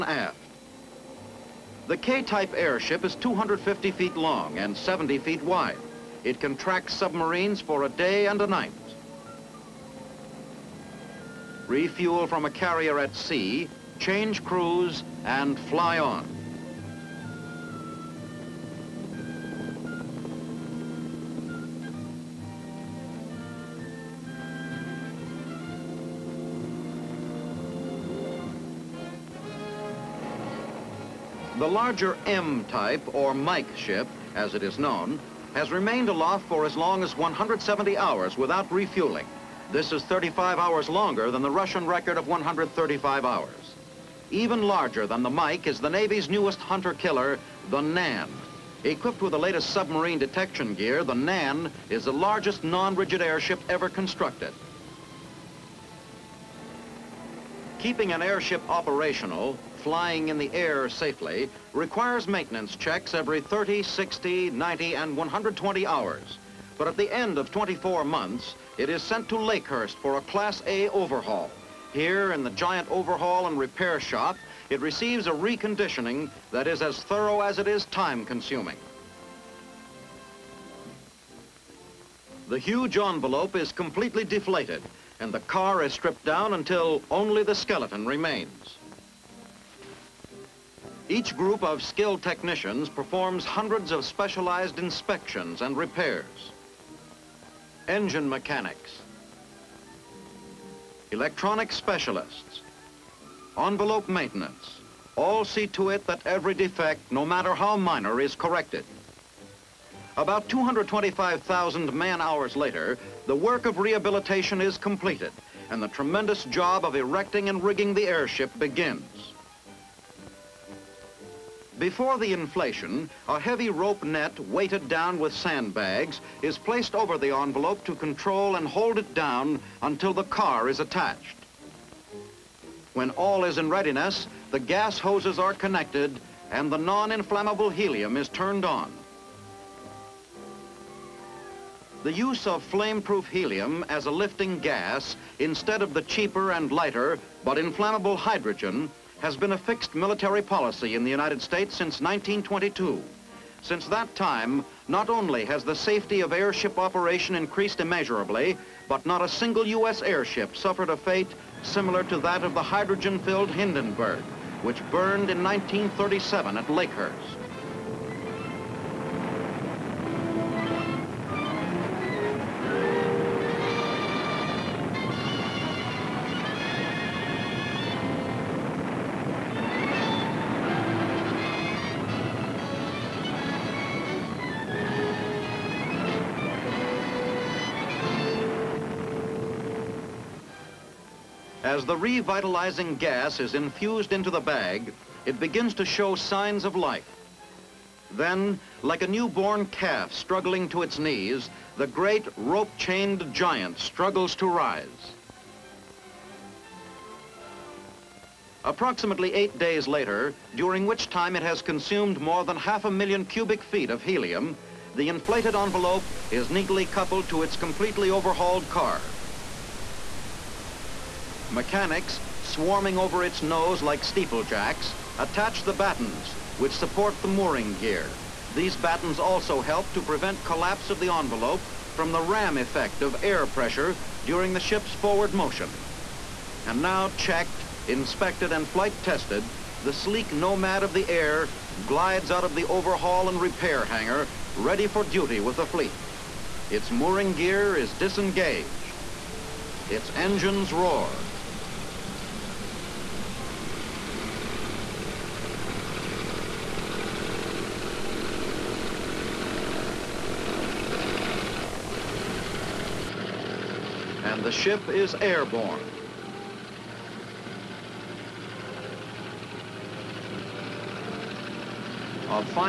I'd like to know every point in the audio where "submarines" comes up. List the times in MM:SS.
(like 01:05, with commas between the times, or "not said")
00:06, 00:49.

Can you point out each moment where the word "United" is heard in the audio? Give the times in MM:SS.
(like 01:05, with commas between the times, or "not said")
02:31.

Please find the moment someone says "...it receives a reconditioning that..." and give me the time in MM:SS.
01:14.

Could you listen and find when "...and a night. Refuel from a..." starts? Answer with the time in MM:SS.
00:08.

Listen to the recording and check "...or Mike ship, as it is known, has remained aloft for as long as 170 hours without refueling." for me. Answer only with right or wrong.
right.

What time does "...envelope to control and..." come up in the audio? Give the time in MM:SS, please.
02:07.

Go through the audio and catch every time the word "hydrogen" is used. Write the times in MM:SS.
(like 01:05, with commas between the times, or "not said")
02:28, 02:42.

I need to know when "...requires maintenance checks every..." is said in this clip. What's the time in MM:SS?
01:01.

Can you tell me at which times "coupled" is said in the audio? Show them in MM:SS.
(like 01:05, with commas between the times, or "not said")
03:36.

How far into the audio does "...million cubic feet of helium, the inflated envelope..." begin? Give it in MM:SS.
03:32.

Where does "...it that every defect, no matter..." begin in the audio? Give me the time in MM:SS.
01:45.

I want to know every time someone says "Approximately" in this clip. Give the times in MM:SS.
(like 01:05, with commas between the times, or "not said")
03:28.